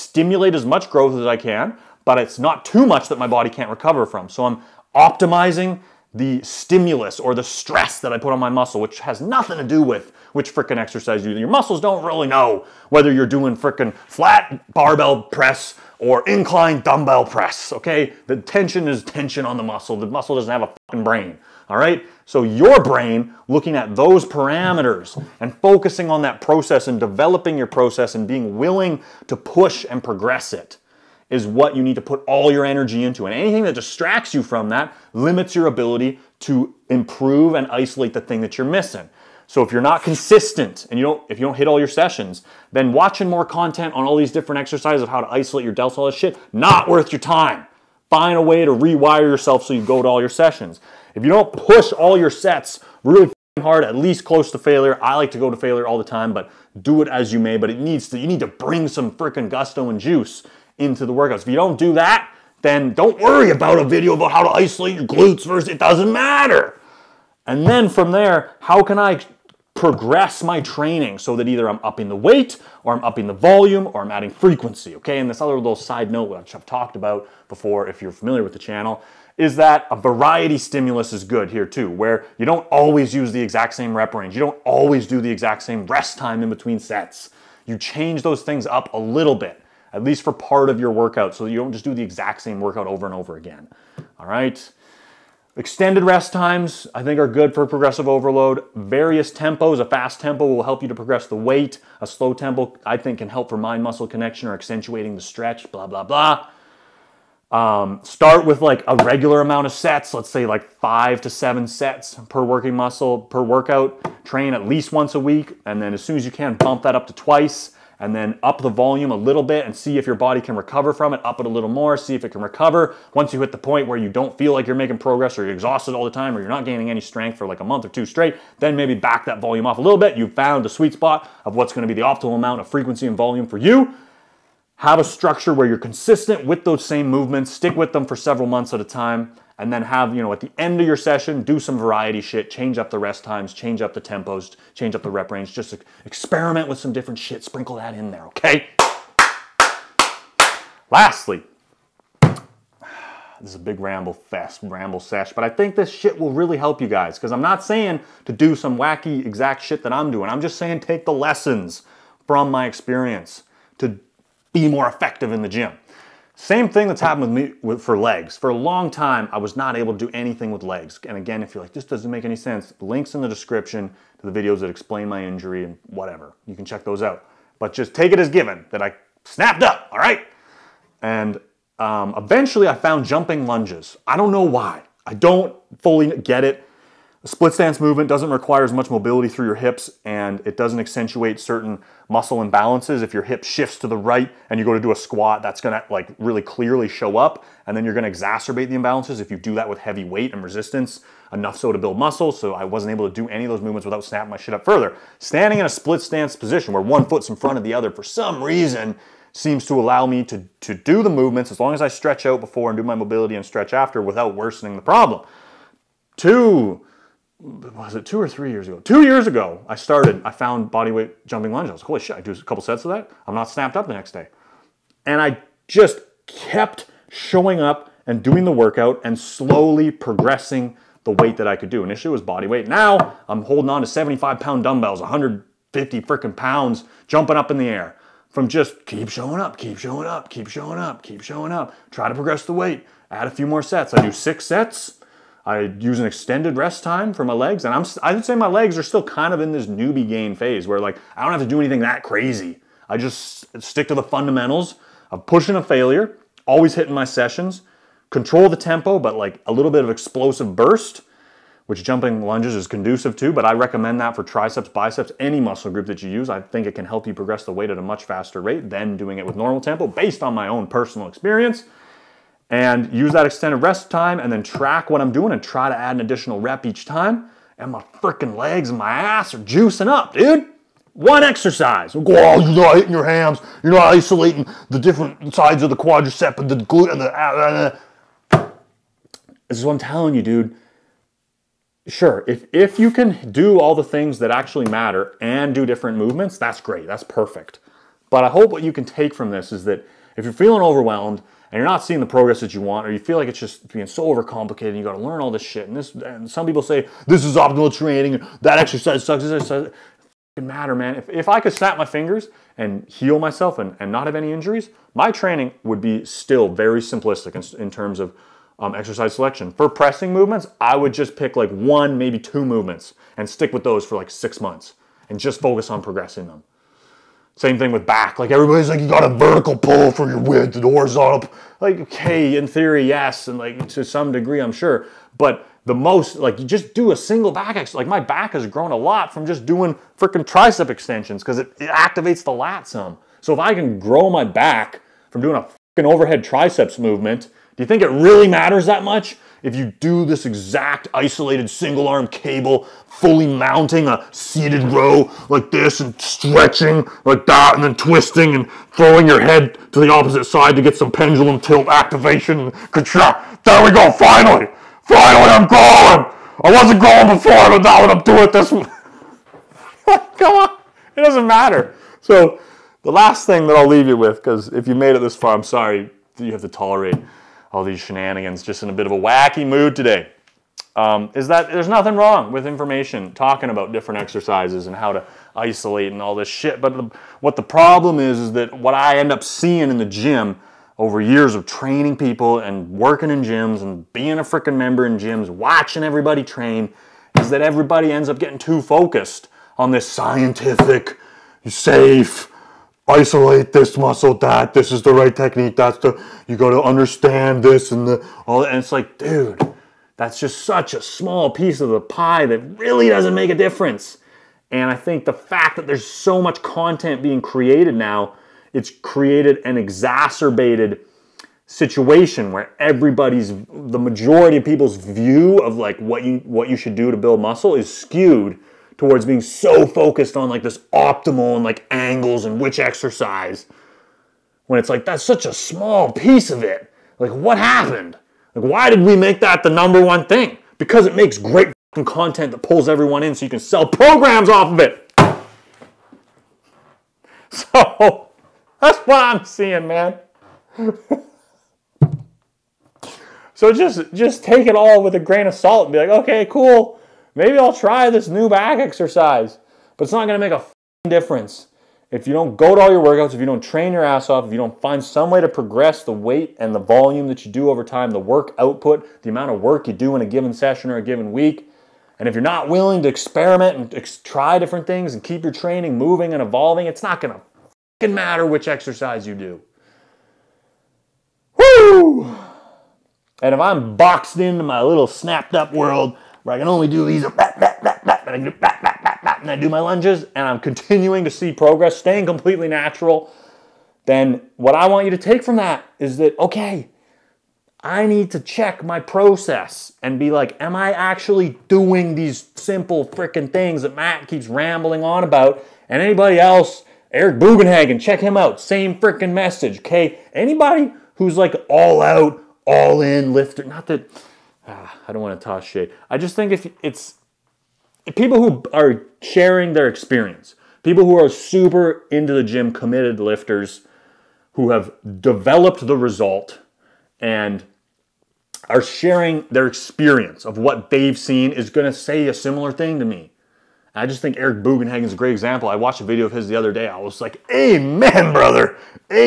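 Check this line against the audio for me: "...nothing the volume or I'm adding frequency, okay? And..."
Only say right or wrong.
wrong.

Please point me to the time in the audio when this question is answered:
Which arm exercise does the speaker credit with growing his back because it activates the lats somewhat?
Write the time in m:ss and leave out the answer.
5:40.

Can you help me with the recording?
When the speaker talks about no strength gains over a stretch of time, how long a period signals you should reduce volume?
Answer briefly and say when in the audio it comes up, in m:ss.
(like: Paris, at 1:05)
a month or two, at 2:07.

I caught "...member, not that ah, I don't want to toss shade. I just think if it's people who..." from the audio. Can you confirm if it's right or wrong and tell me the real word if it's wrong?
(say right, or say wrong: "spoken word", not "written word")
wrong: "lifter", not "member".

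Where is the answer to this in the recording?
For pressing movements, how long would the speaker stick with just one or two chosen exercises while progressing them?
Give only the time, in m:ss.
5:24.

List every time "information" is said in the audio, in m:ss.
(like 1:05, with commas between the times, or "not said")
6:22.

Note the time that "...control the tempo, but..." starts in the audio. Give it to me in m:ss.
4:18.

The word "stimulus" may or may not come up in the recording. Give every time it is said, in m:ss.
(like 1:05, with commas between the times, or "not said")
0:06, 1:20.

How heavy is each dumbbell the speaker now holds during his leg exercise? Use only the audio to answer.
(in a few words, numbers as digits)
75 pounds.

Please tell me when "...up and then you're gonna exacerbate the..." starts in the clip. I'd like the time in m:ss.
3:17.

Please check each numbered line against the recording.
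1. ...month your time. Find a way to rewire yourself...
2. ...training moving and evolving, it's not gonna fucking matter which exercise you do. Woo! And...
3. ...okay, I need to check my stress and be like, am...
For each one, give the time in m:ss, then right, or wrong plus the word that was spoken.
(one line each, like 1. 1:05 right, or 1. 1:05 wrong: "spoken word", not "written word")
1. 0:46 wrong: "worth", not "month"
2. 7:55 right
3. 8:16 wrong: "process", not "stress".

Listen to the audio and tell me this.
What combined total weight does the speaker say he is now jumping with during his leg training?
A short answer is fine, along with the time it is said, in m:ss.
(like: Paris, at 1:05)
150 pounds, at 3:55.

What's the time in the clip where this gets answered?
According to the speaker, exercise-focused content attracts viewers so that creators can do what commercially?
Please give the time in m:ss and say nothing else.
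7:23.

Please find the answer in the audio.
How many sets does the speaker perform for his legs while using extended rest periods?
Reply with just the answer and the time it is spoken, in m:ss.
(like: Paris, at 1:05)
6 sets, at 4:04.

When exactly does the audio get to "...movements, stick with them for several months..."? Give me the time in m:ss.
2:17.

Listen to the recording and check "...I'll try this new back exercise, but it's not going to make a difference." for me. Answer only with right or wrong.
right.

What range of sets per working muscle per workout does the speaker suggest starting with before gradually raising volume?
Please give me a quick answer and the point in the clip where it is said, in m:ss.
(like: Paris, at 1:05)
5 to 7 sets, at 1:50.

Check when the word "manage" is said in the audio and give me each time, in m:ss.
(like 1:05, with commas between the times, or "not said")
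not said.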